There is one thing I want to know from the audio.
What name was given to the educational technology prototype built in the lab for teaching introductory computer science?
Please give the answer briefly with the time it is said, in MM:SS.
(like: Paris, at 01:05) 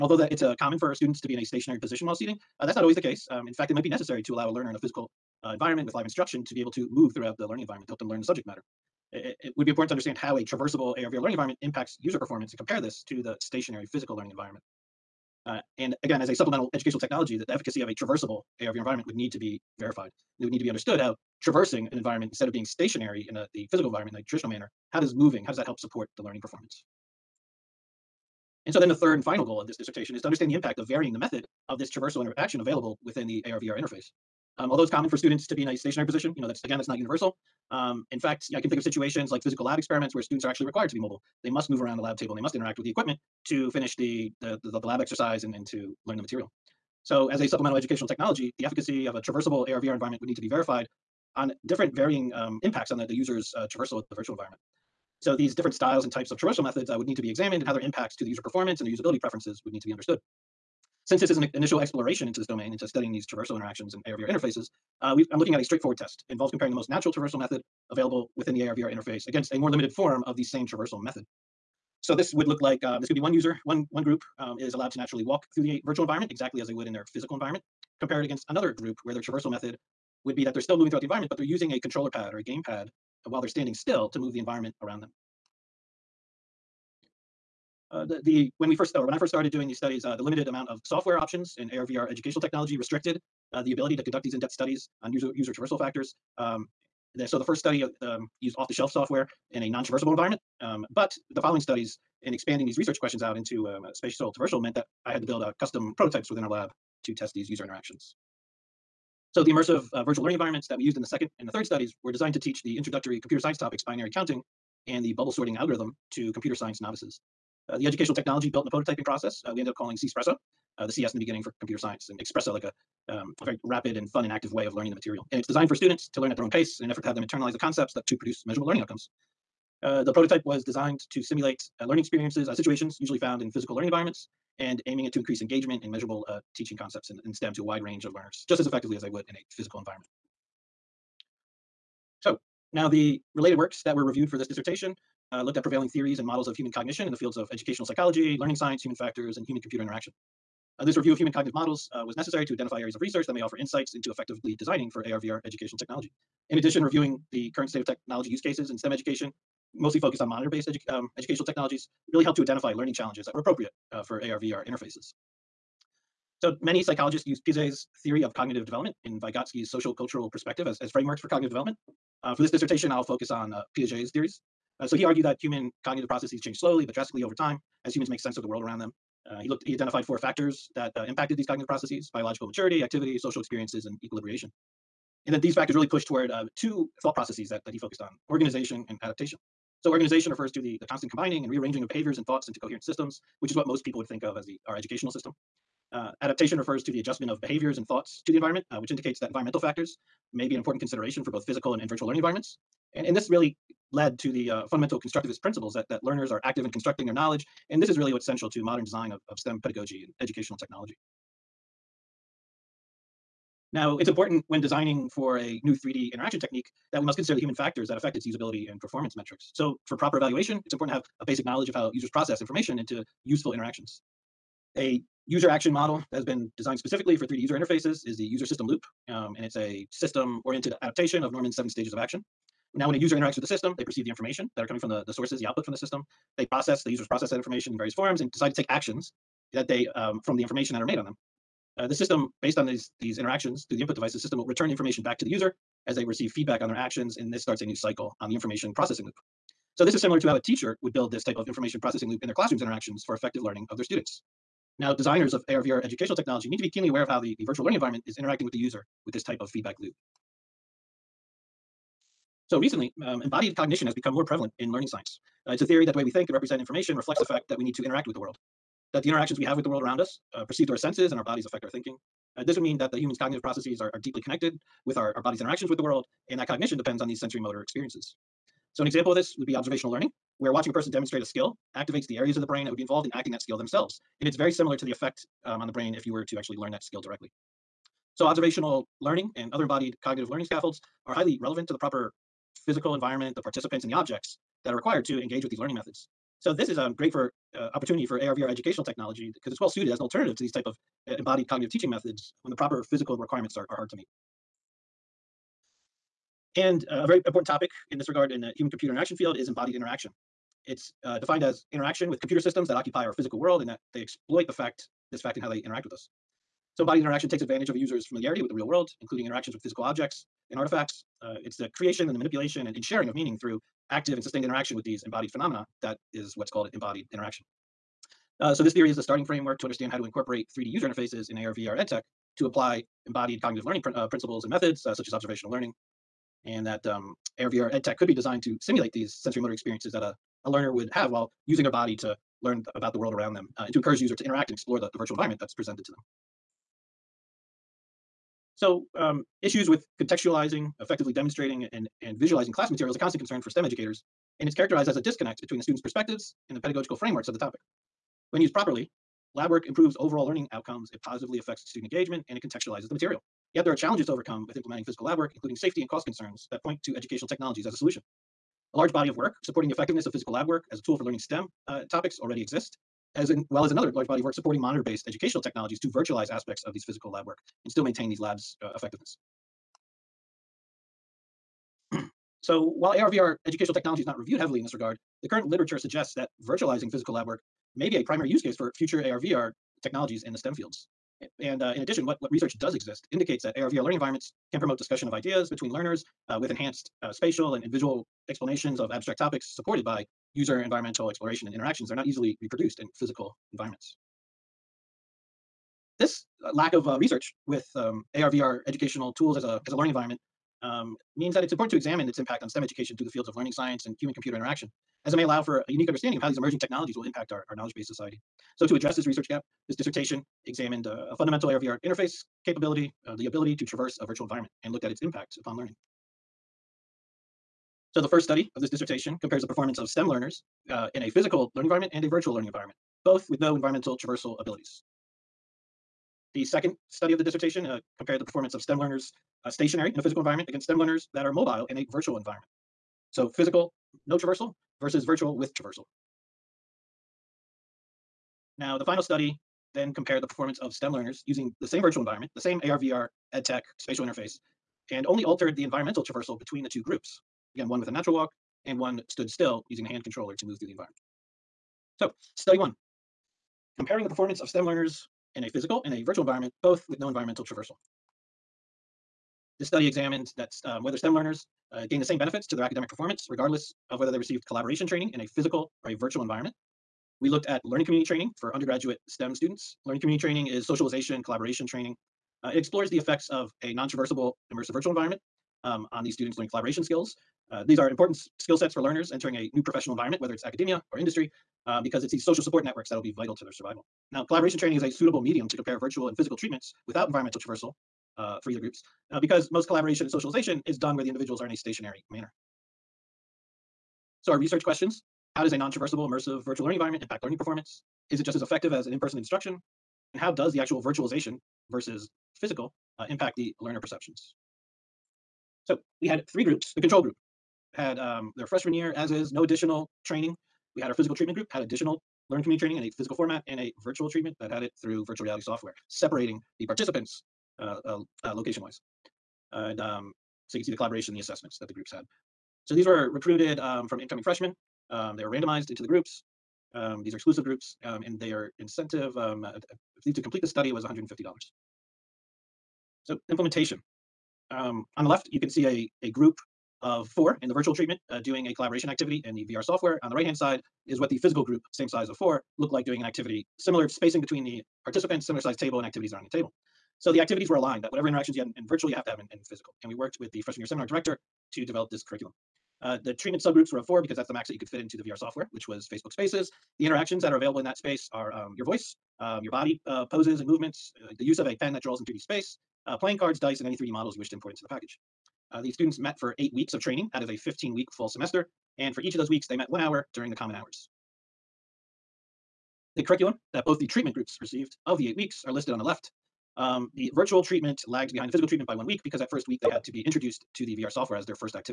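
CSpresso, at 01:59.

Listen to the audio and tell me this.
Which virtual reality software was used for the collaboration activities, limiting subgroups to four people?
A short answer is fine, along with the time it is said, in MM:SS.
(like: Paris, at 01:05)
Facebook Spaces, at 09:25.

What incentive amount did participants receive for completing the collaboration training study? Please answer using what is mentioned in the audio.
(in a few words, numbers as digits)
$150.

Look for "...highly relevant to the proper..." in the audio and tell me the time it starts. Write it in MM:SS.
04:51.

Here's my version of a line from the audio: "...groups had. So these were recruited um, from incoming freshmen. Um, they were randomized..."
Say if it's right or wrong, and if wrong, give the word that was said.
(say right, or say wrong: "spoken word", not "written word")
right.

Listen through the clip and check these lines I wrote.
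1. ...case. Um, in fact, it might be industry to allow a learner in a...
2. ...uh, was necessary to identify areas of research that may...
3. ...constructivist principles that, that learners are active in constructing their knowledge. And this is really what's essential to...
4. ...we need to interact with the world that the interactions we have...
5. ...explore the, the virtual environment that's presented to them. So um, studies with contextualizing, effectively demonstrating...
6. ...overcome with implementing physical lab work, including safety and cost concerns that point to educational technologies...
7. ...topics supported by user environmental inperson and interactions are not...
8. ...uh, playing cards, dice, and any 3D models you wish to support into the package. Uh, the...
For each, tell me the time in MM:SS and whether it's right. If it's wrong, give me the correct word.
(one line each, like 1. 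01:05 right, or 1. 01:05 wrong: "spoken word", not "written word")
1. 00:02 wrong: "necessary", not "industry"
2. 02:31 right
3. 03:25 right
4. 04:27 right
5. 05:44 wrong: "issues", not "studies"
6. 06:04 right
7. 06:39 wrong: "exploration", not "inperson"
8. 09:32 wrong: "import", not "support".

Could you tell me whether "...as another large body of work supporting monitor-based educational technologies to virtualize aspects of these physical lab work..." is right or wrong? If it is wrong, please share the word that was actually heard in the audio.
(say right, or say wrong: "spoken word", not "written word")
right.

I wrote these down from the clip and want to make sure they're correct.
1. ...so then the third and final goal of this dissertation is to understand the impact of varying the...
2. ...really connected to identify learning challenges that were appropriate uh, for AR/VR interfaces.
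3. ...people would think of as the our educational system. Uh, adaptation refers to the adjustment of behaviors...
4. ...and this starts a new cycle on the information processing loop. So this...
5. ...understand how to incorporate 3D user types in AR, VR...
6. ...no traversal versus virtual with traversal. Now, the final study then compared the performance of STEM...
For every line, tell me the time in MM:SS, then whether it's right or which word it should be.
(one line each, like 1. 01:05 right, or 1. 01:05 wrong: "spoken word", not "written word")
1. 00:28 right
2. 02:42 wrong: "helped", not "connected"
3. 03:13 right
4. 04:07 right
5. 05:29 wrong: "interfaces", not "types"
6. 07:24 right.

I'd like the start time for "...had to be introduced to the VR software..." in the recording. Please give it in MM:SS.
09:49.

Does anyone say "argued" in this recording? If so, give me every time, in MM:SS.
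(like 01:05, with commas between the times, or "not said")
02:55.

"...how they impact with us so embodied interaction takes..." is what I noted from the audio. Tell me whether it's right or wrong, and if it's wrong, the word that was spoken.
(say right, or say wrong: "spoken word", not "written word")
wrong: "interact", not "impact".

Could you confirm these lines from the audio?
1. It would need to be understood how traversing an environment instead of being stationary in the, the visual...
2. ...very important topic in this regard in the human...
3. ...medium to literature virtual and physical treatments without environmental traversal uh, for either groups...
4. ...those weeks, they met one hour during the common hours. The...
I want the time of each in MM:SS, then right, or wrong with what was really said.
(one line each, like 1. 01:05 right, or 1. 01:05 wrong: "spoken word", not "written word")
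1. 00:20 wrong: "physical", not "visual"
2. 05:07 right
3. 08:15 wrong: "compare", not "literature"
4. 09:39 right.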